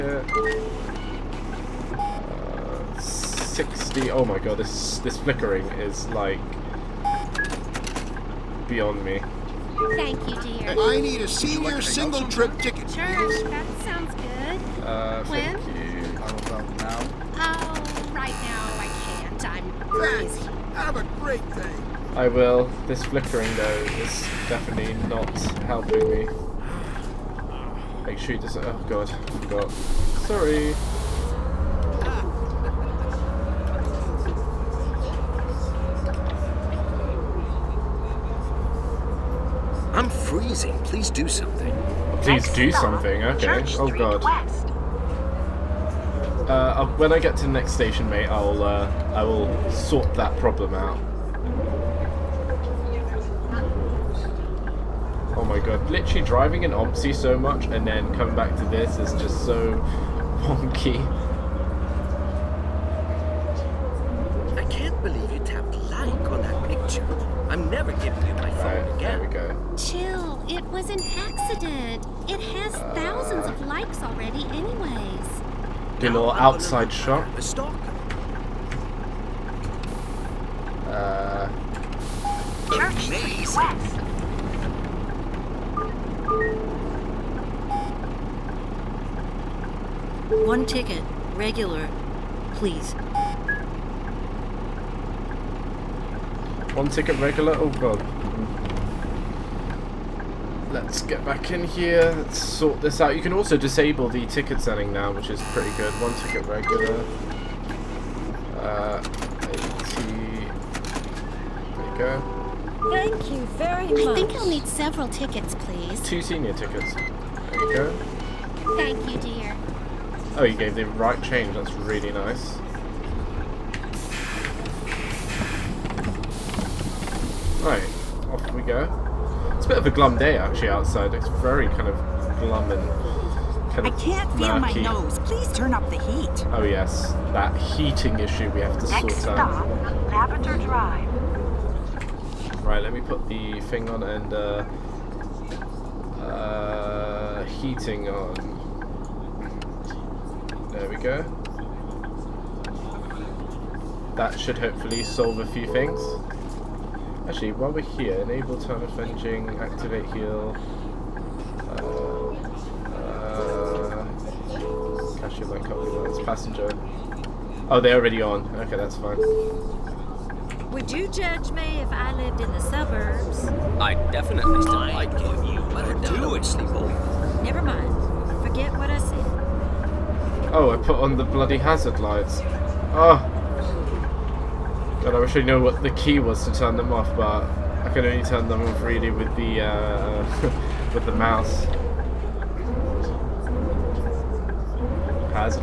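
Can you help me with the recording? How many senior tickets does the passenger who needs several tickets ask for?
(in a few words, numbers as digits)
2.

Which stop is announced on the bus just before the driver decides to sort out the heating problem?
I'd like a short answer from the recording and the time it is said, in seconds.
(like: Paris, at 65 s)
Lavender Drive, at 140 s.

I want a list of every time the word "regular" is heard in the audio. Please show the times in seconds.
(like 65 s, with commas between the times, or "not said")
91 s, 97 s, 106 s.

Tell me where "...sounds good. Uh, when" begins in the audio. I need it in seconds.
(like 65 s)
13 s.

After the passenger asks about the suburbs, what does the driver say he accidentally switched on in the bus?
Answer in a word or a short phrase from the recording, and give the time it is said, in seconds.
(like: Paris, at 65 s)
hazard lights, at 181 s.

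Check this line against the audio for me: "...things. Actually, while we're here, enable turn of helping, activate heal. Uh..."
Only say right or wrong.
wrong.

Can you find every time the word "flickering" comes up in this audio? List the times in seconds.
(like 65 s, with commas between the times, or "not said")
5 s, 23 s.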